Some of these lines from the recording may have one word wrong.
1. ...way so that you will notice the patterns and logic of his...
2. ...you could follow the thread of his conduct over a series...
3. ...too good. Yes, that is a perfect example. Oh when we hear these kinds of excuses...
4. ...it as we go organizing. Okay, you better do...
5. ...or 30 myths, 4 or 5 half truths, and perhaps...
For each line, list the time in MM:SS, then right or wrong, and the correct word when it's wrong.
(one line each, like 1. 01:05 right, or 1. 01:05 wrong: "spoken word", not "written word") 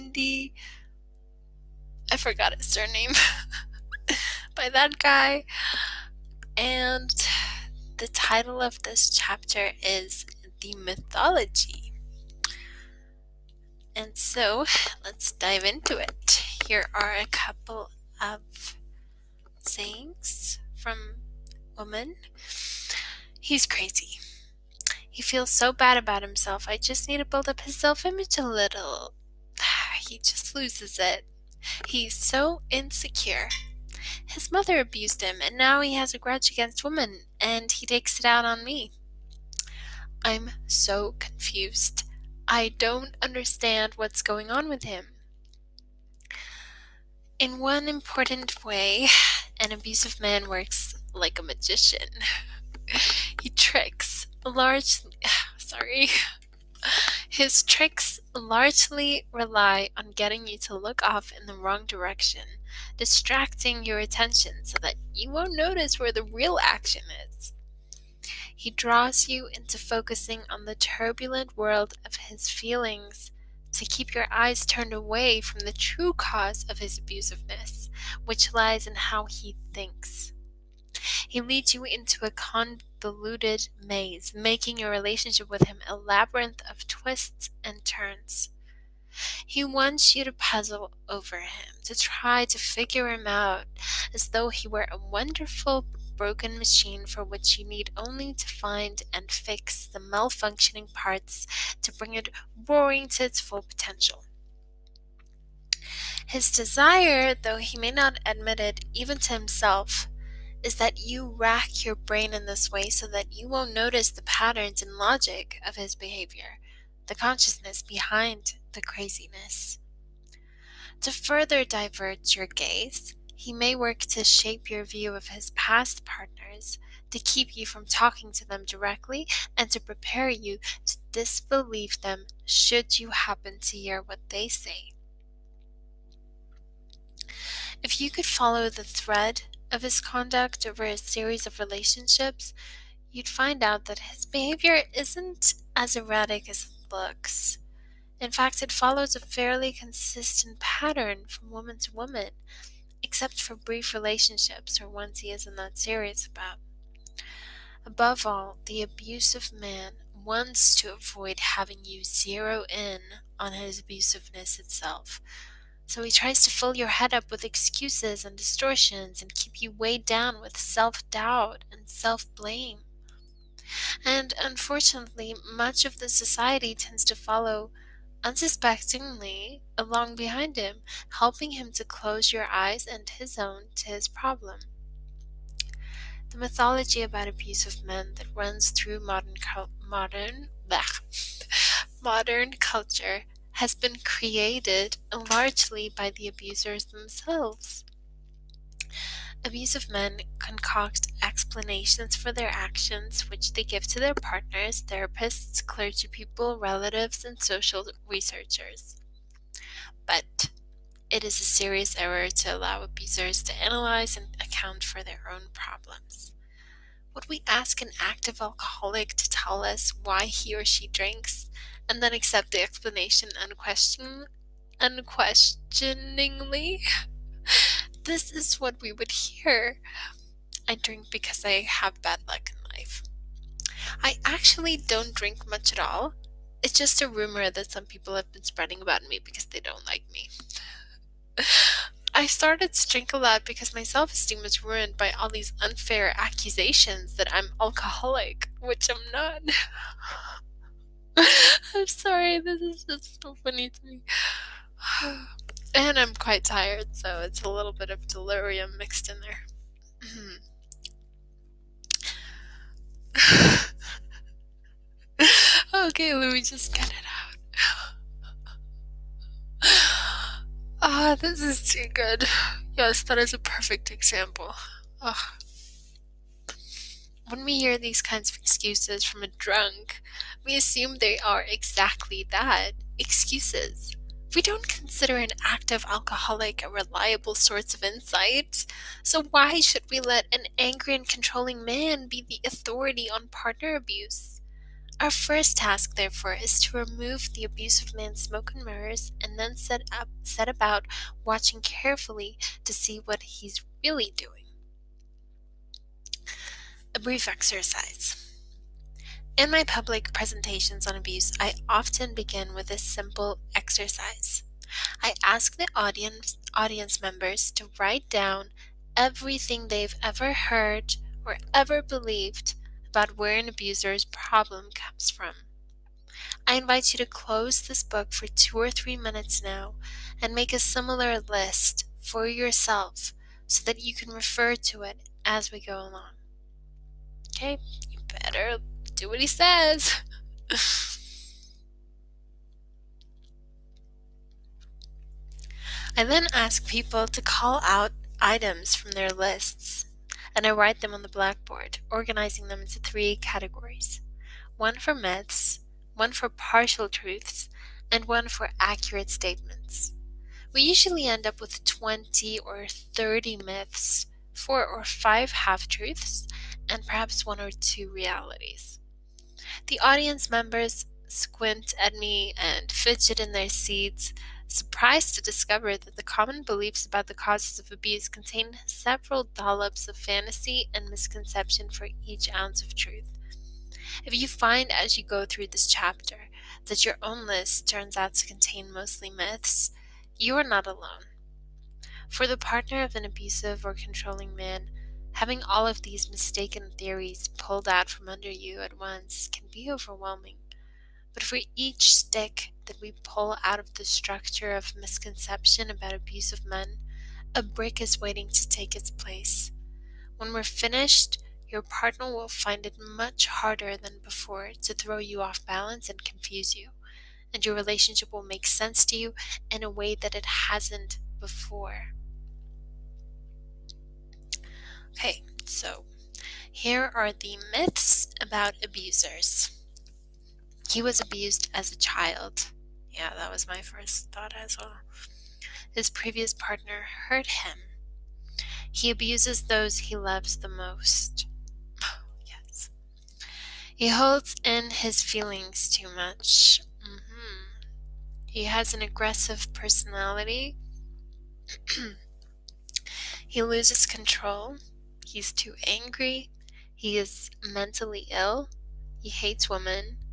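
1. 01:52 right
2. 02:17 right
3. 04:31 right
4. 05:34 wrong: "along", not "organizing"
5. 06:02 right.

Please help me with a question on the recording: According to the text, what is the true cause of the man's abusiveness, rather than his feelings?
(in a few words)
how he thinks.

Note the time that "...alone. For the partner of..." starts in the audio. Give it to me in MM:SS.
06:30.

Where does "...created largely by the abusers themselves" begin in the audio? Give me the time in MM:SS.
03:14.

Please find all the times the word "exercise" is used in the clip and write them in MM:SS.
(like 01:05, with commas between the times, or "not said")
05:07, 05:13.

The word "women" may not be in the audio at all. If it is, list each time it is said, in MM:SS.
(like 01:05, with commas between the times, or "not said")
00:21, 00:36, 07:39.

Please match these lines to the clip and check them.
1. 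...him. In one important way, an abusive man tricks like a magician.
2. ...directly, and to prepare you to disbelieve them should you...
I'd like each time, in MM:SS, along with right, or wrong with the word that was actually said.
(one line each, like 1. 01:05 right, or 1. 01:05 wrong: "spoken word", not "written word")
1. 00:44 wrong: "works", not "tricks"
2. 02:08 right.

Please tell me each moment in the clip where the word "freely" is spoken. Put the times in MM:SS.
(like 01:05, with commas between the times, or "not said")
not said.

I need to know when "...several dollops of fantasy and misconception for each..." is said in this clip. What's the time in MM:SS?
06:18.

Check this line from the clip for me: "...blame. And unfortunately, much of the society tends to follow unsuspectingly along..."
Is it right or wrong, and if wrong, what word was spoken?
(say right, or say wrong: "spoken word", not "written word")
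right.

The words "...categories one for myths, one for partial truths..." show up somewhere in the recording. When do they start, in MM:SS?
05:53.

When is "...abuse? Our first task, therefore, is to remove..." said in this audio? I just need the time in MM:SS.
04:53.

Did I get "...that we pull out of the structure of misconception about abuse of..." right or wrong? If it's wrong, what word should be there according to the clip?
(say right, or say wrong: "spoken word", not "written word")
right.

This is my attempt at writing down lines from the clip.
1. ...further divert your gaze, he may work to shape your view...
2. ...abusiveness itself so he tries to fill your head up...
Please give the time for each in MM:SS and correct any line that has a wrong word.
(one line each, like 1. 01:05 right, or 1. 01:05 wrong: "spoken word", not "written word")
1. 02:01 right
2. 02:43 right.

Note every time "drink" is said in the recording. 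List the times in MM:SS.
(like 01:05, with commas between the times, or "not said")
03:40, 03:50, 03:55, 04:02.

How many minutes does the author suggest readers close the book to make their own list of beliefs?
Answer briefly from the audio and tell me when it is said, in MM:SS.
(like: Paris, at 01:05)
2 or 3, at 05:28.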